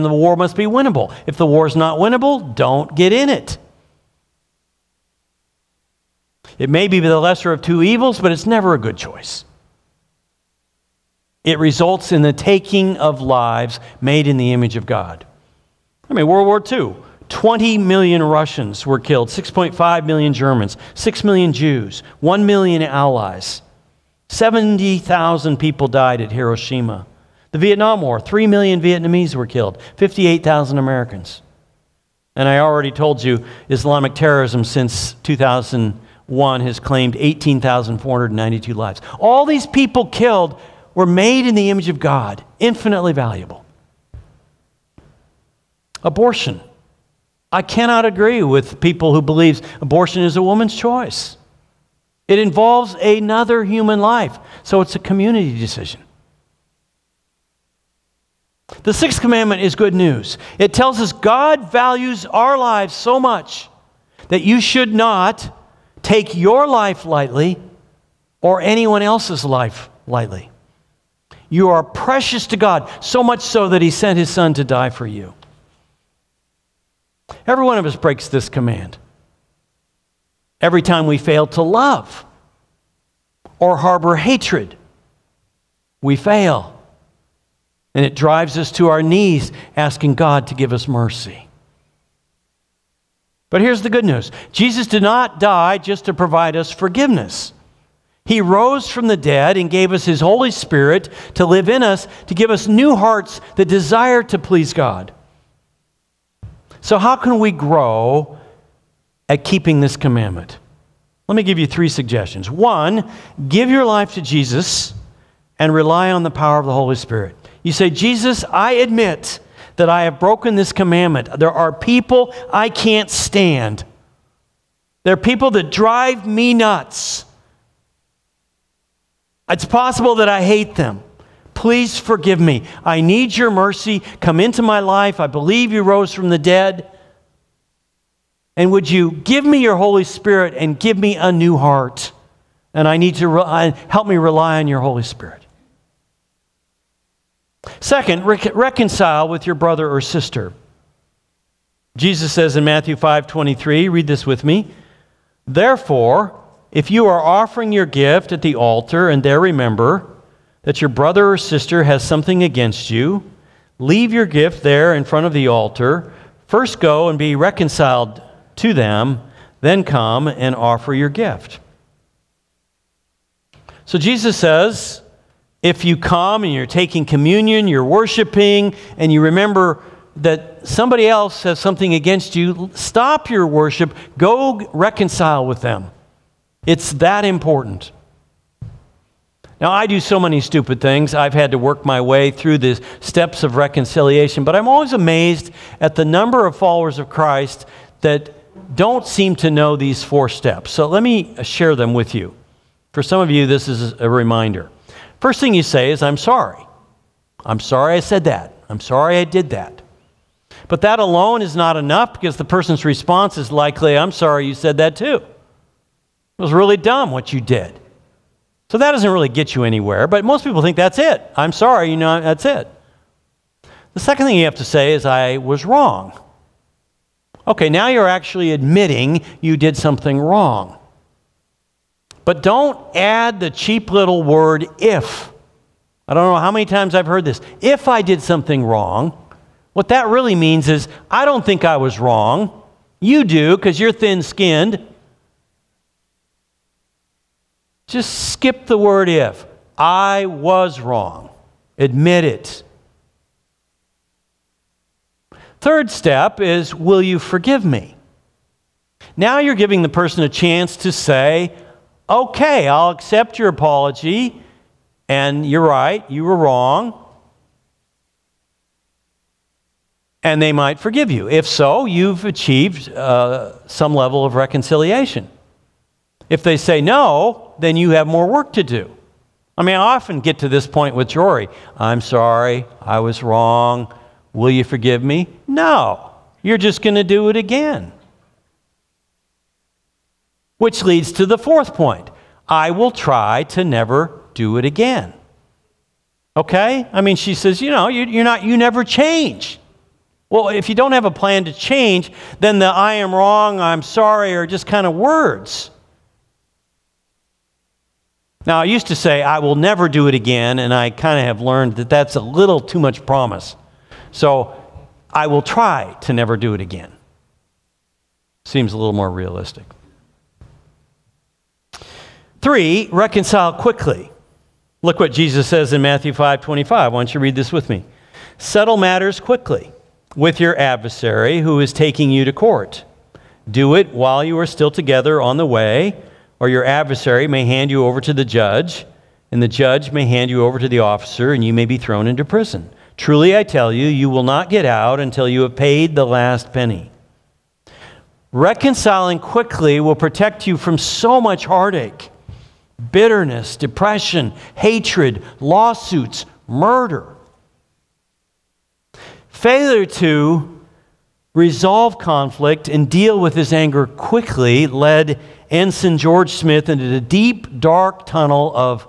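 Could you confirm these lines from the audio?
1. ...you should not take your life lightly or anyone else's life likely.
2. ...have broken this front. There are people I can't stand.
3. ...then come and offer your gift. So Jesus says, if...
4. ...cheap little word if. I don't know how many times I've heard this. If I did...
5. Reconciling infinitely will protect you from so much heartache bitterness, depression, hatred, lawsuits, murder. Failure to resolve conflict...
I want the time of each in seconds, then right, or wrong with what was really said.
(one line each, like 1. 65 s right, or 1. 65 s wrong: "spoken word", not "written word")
1. 64 s wrong: "lightly", not "likely"
2. 120 s wrong: "commandment", not "front"
3. 169 s right
4. 233 s right
5. 348 s wrong: "quickly", not "infinitely".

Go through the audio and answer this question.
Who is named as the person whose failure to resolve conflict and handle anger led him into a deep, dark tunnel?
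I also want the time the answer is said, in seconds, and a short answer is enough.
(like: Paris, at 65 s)
Ensign George Smith, at 365 s.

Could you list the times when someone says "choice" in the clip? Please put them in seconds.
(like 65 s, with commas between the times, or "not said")
8 s, 50 s.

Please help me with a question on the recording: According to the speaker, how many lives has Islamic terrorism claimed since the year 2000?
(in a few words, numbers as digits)
18,492.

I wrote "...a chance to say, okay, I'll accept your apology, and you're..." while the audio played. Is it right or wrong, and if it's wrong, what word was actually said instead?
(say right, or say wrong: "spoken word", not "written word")
right.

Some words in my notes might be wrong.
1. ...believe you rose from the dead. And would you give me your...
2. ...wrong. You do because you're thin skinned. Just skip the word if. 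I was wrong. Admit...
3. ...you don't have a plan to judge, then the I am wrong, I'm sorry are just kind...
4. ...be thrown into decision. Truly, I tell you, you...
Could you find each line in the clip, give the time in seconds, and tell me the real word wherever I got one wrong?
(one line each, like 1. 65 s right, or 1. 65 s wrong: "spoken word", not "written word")
1. 135 s right
2. 241 s right
3. 300 s wrong: "change", not "judge"
4. 341 s wrong: "prison", not "decision".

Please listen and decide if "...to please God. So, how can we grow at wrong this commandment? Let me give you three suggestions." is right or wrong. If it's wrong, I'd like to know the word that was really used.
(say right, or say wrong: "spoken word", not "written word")
wrong: "keeping", not "wrong".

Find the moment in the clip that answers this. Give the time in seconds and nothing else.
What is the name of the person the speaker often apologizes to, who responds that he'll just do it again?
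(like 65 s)
281 s.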